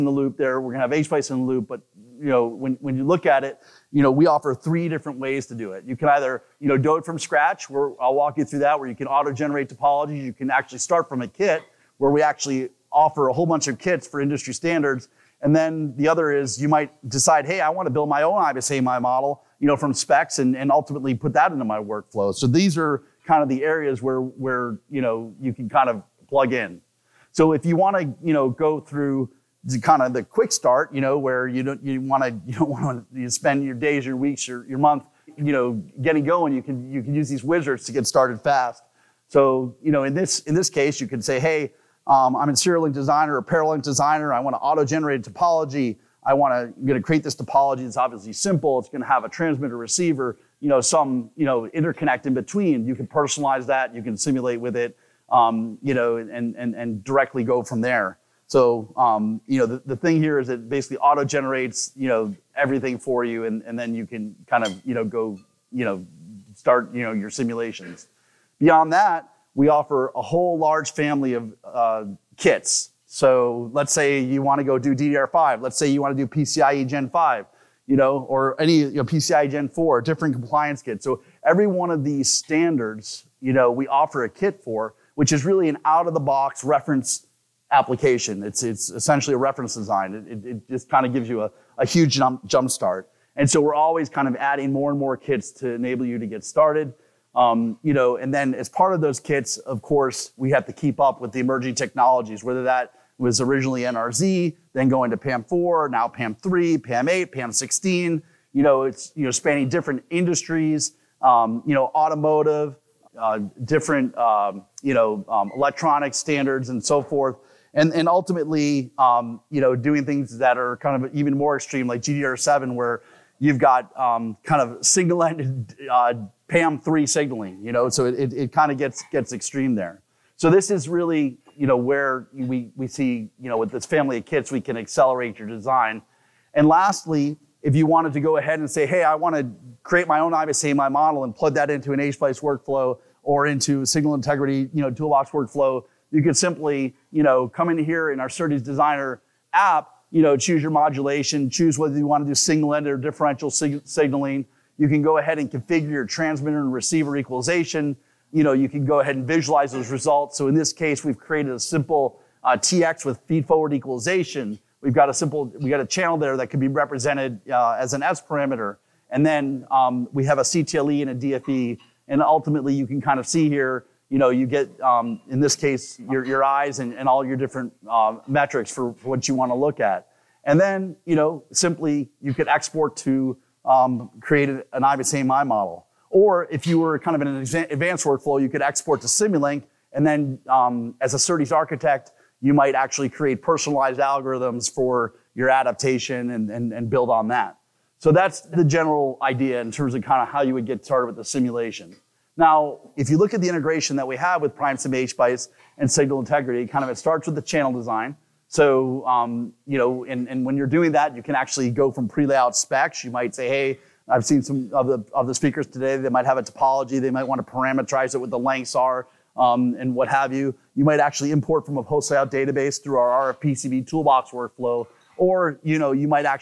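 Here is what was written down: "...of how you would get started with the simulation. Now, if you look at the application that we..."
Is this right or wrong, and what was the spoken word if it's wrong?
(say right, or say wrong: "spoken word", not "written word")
wrong: "integration", not "application".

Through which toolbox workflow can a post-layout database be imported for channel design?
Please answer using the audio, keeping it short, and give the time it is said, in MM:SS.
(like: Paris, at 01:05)
RFPCB toolbox, at 03:43.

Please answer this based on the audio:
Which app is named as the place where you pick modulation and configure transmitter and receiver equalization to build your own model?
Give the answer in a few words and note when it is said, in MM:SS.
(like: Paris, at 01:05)
SerDes Designer, at 02:28.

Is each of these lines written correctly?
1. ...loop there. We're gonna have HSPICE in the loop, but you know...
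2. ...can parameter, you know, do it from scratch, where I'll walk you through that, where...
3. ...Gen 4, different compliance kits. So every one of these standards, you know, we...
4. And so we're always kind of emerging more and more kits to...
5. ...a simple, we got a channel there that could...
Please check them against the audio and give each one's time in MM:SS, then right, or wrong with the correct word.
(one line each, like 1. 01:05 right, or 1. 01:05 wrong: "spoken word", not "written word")
1. 00:00 right
2. 00:05 wrong: "either", not "parameter"
3. 01:19 right
4. 01:33 wrong: "adding", not "emerging"
5. 02:45 right.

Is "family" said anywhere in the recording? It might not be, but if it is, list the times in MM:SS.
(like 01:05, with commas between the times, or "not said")
01:10, 02:13.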